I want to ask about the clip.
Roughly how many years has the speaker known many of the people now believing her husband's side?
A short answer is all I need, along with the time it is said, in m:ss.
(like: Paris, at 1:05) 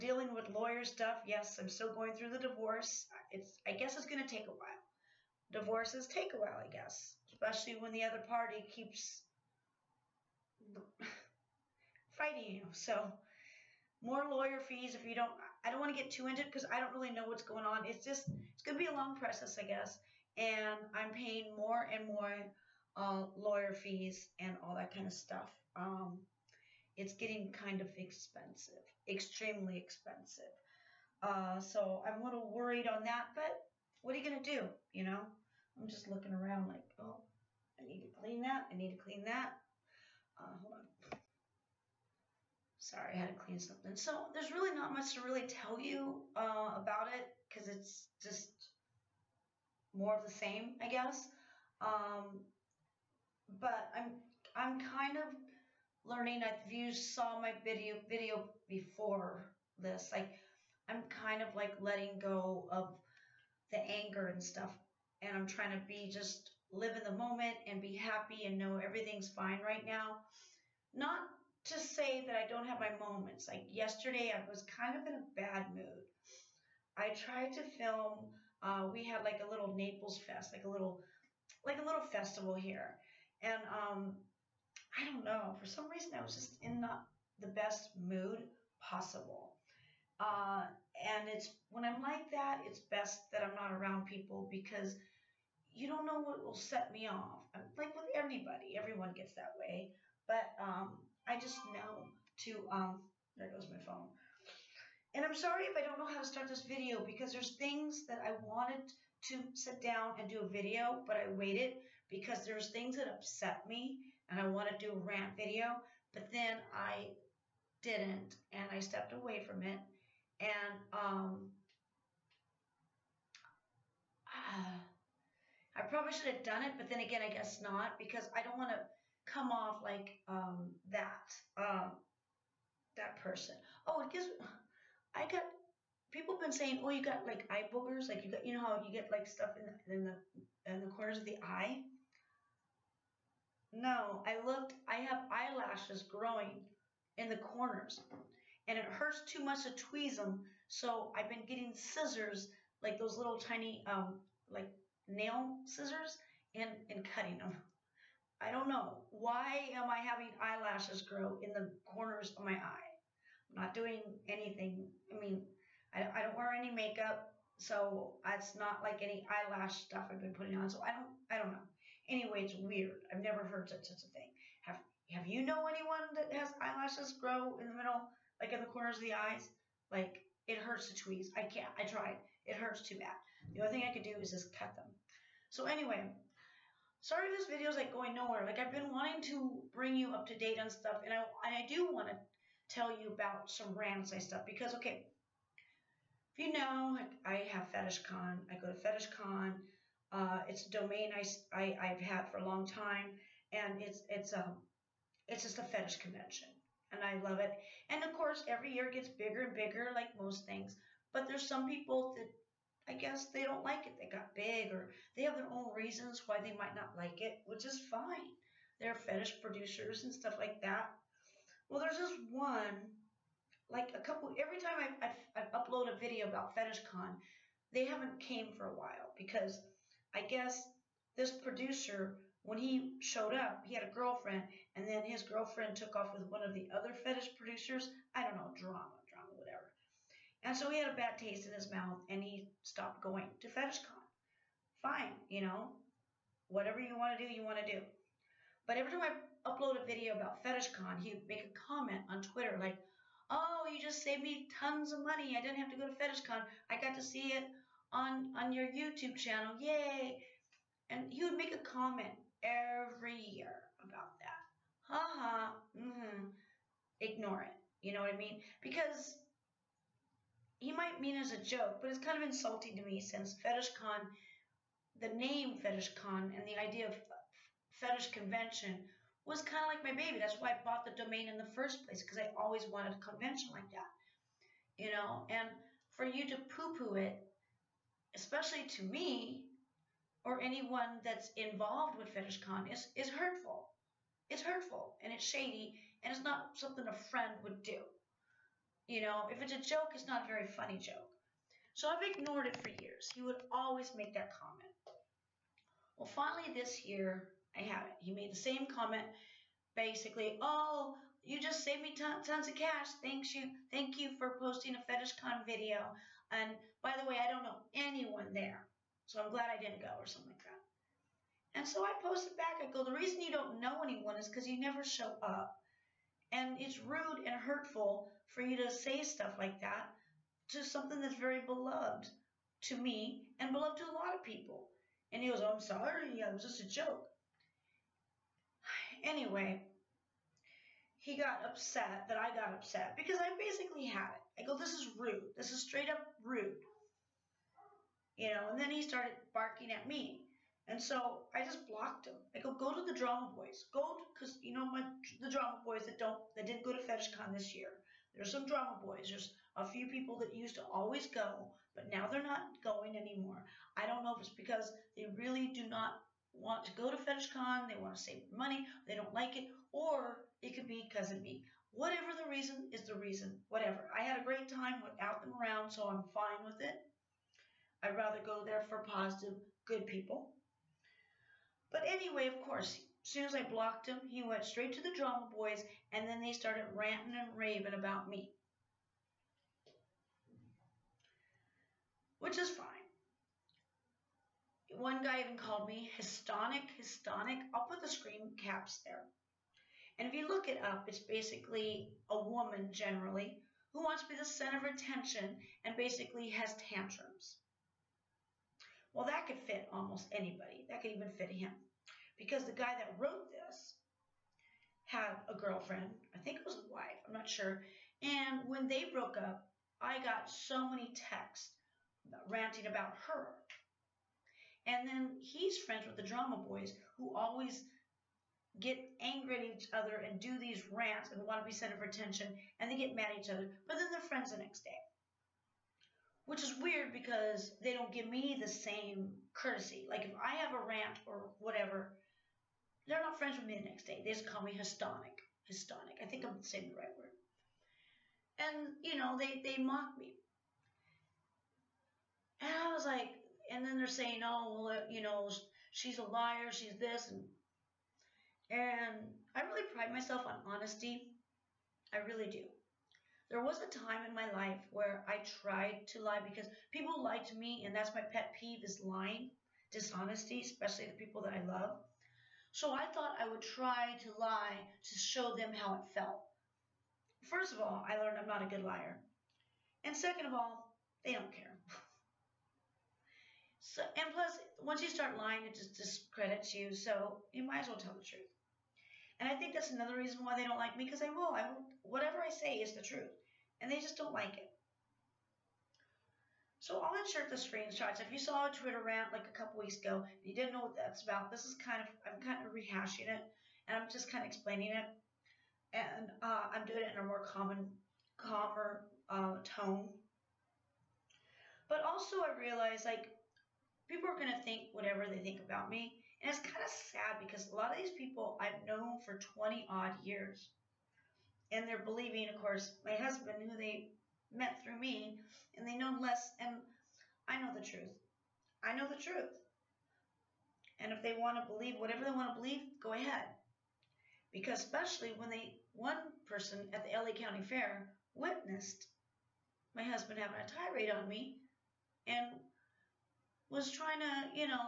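20, at 8:39.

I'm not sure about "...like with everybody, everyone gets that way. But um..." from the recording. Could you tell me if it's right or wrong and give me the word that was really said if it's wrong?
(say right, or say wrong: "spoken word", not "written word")
right.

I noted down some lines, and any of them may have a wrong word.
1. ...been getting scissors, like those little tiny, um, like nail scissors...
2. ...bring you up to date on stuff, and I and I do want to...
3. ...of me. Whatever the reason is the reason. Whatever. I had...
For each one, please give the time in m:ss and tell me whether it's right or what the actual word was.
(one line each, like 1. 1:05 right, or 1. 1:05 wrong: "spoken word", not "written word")
1. 2:31 right
2. 3:09 right
3. 6:11 right.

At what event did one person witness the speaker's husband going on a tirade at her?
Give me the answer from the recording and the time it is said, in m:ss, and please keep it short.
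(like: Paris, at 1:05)
LA County Fair, at 8:56.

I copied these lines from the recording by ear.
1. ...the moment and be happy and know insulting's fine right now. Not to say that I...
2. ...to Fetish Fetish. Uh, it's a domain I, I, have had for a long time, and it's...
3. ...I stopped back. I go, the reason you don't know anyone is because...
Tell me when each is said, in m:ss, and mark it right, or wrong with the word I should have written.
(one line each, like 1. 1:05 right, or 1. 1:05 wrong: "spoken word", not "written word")
1. 1:07 wrong: "everything", not "insulting"
2. 3:18 wrong: "Con", not "Fetish"
3. 5:21 wrong: "posted", not "stopped".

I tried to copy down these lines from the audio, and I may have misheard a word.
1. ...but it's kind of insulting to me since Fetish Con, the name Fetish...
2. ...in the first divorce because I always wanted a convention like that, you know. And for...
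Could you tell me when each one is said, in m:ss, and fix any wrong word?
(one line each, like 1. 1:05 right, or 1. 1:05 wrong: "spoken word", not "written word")
1. 4:31 right
2. 4:41 wrong: "place", not "divorce".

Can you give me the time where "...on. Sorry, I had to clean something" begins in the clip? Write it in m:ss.
0:40.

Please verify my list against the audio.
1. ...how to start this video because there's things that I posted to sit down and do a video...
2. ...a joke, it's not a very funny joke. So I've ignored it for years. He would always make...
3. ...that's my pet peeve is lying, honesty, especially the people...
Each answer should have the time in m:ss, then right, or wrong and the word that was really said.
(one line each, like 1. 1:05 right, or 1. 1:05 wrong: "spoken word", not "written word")
1. 1:46 wrong: "wanted", not "posted"
2. 4:59 right
3. 7:47 wrong: "dishonesty", not "honesty".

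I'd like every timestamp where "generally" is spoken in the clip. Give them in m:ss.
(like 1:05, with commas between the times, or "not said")
6:42.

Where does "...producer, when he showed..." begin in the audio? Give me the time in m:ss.
3:51.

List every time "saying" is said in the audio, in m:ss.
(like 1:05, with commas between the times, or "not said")
2:16, 7:26, 7:33.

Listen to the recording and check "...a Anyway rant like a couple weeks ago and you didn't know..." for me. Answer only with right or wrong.
wrong.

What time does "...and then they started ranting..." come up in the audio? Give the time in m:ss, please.
6:25.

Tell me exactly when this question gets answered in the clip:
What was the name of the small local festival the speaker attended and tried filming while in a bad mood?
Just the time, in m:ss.
1:19.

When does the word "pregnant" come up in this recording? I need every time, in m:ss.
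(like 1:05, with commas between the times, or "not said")
not said.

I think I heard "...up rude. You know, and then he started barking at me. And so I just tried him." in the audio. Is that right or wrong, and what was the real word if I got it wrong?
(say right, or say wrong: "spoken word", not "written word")
wrong: "blocked", not "tried".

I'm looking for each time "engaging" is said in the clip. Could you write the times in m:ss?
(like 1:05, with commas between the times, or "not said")
not said.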